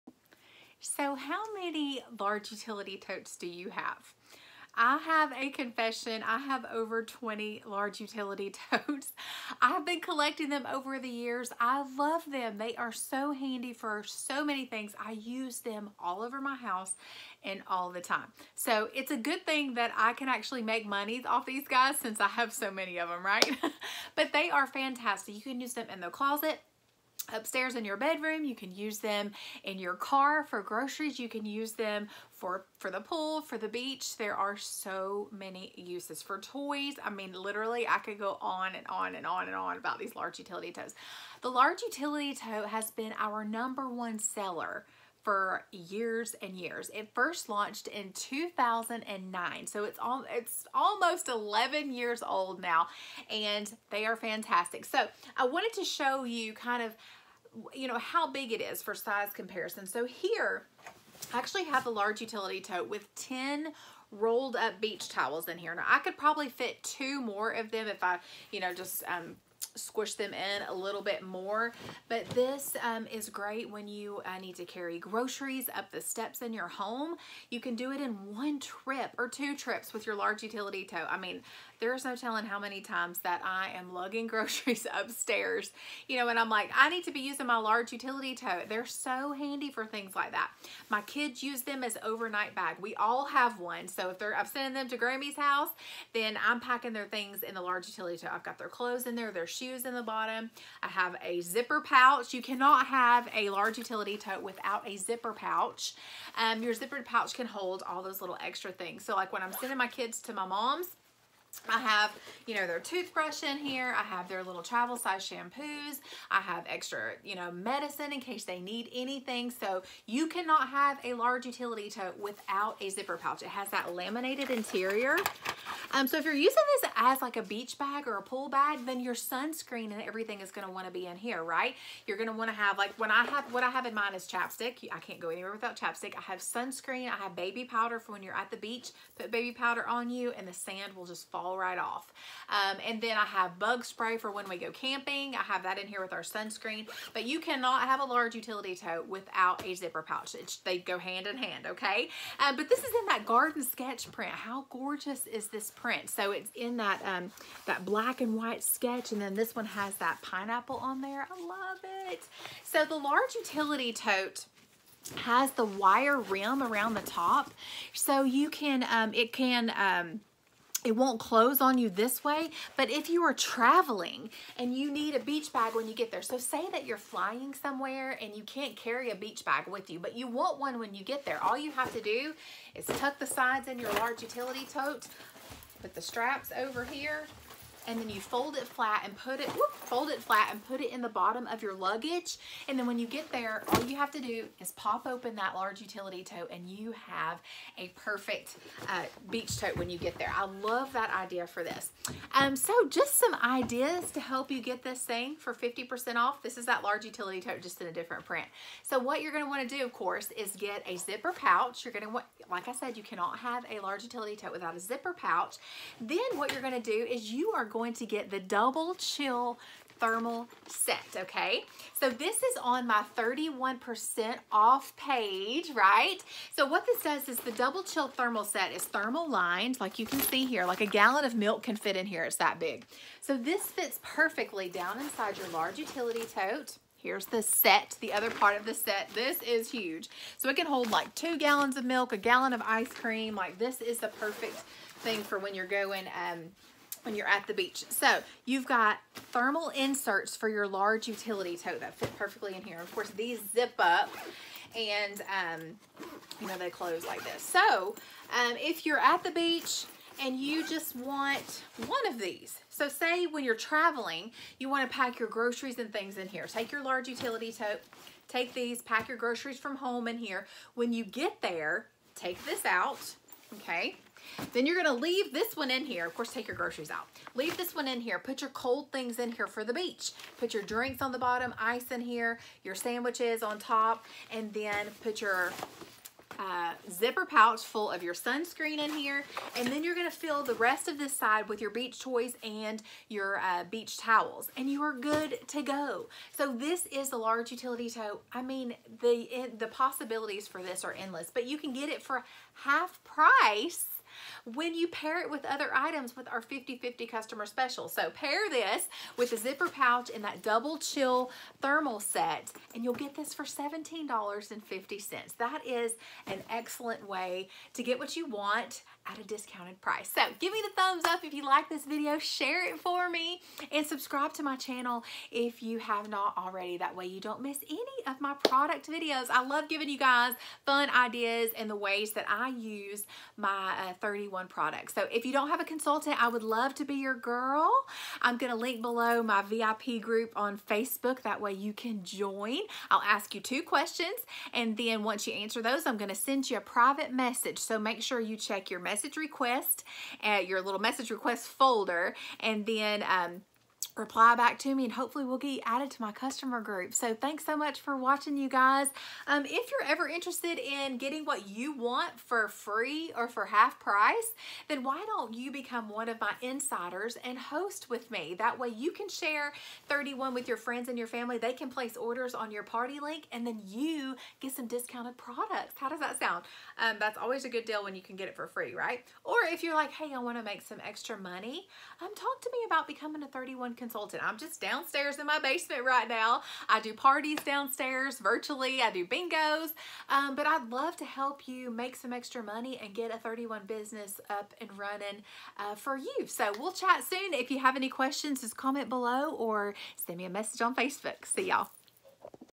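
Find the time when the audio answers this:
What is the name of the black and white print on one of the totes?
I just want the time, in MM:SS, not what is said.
02:33.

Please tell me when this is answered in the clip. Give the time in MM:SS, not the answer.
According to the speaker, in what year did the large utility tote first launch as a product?
00:48.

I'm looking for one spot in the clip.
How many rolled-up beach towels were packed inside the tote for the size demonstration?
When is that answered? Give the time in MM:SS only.
01:03.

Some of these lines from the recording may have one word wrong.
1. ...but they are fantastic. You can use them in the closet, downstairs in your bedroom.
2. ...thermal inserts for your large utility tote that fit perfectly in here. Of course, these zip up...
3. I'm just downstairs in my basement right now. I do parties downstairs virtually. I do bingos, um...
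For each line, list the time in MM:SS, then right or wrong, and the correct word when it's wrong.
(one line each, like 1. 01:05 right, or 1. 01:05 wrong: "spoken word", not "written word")
1. 00:24 wrong: "upstairs", not "downstairs"
2. 04:09 right
3. 06:24 right.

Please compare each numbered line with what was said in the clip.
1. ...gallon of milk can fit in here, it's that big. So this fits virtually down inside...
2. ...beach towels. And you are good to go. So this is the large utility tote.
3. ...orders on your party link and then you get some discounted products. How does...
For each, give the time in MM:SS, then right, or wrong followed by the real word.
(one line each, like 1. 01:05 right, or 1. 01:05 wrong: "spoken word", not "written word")
1. 03:50 wrong: "perfectly", not "virtually"
2. 04:53 right
3. 06:11 right.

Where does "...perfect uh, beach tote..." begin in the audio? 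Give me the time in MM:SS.
03:17.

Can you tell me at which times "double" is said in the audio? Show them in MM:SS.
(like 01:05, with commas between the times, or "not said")
03:38, 03:47, 05:10.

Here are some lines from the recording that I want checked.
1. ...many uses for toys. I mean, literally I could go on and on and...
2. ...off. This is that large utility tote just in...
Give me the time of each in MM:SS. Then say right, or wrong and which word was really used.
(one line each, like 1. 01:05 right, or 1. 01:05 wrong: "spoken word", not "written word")
1. 00:35 right
2. 03:26 right.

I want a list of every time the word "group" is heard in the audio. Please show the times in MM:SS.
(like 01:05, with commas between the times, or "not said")
05:40, 05:56.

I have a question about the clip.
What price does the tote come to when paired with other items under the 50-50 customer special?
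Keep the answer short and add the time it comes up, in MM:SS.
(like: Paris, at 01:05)
$17.50, at 05:13.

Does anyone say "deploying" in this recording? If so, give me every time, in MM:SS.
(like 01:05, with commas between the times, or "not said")
not said.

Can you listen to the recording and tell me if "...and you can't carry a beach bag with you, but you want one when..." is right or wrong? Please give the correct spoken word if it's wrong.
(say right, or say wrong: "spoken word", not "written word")
right.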